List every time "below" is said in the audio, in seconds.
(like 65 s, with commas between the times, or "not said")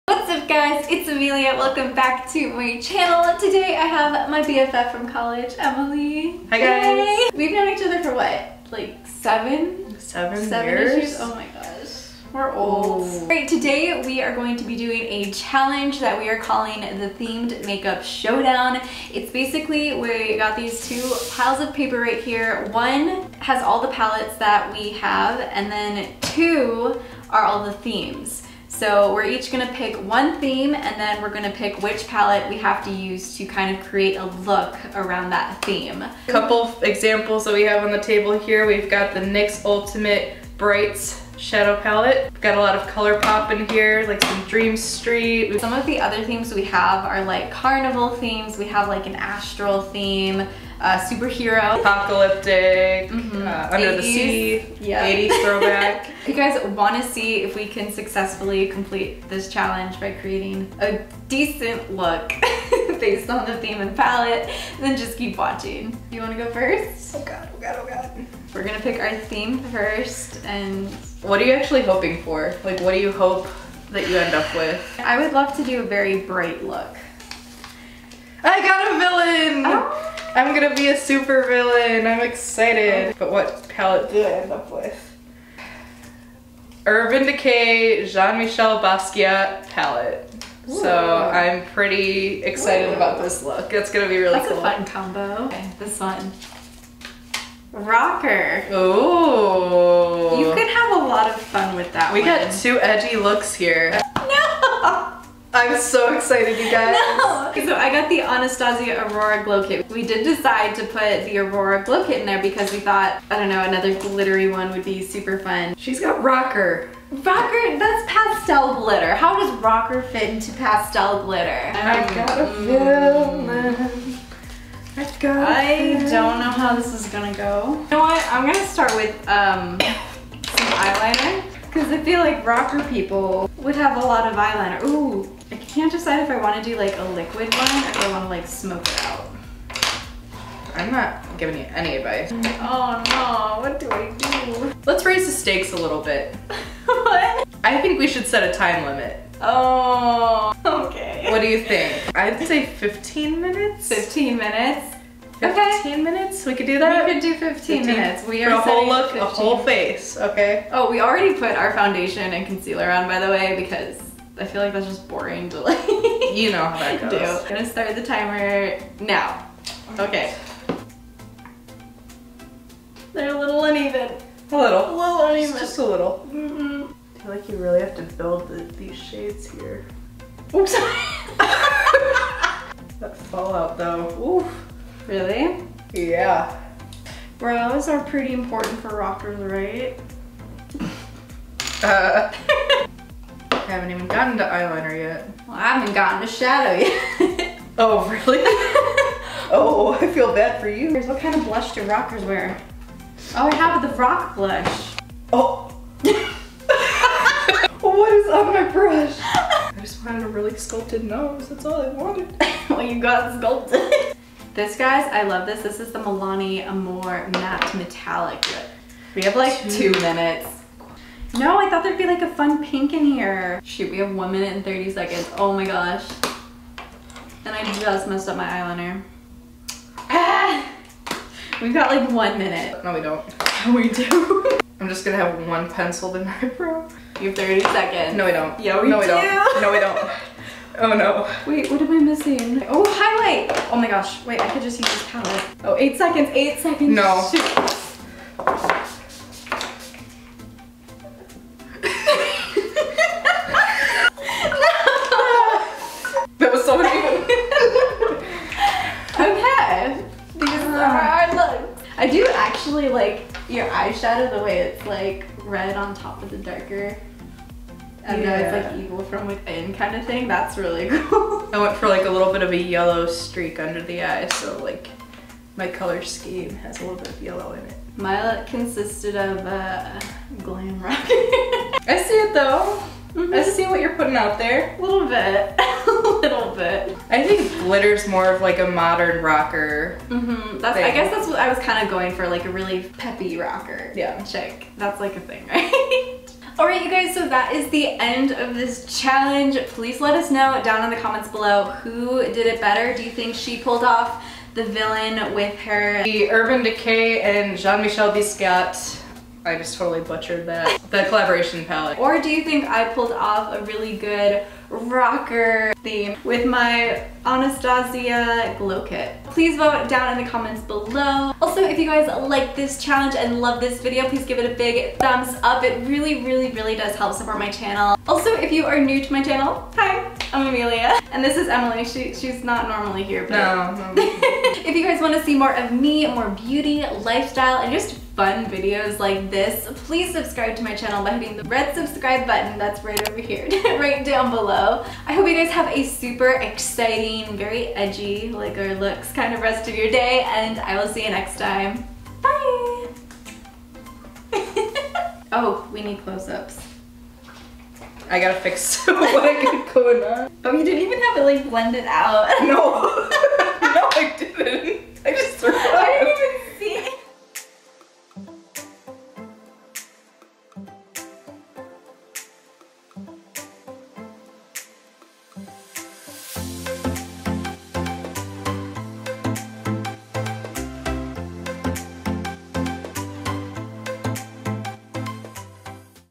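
301 s, 320 s, 344 s.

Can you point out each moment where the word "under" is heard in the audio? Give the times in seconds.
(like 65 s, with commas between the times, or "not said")
53 s, 273 s.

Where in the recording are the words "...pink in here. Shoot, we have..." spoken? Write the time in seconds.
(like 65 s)
222 s.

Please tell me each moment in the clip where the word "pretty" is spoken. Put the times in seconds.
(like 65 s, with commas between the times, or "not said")
91 s, 188 s.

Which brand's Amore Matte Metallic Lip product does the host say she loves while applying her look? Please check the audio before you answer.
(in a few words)
Milani.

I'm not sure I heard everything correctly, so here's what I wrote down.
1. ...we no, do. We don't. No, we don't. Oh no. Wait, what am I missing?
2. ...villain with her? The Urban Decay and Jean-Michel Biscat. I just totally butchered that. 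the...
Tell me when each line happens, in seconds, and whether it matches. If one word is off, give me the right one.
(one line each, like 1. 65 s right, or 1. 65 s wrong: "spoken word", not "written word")
1. 238 s right
2. 304 s right.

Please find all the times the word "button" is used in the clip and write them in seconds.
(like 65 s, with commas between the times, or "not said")
342 s.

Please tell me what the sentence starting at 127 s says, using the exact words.
You know what, I'm gonna start with, um, some eyeliner because I feel like rocker people would have a lot of eyeliner.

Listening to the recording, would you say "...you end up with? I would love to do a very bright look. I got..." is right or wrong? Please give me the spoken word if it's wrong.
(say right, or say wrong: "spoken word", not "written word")
right.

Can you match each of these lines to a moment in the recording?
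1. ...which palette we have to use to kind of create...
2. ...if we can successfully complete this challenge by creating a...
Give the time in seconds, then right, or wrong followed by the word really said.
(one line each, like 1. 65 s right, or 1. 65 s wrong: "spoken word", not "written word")
1. 31 s right
2. 57 s right.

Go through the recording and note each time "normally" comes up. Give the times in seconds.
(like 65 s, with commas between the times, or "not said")
332 s.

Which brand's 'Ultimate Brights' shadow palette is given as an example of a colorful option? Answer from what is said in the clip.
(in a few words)
NYX.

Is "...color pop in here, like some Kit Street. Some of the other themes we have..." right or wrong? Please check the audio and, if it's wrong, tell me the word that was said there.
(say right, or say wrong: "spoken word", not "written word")
wrong: "Dream", not "Kit".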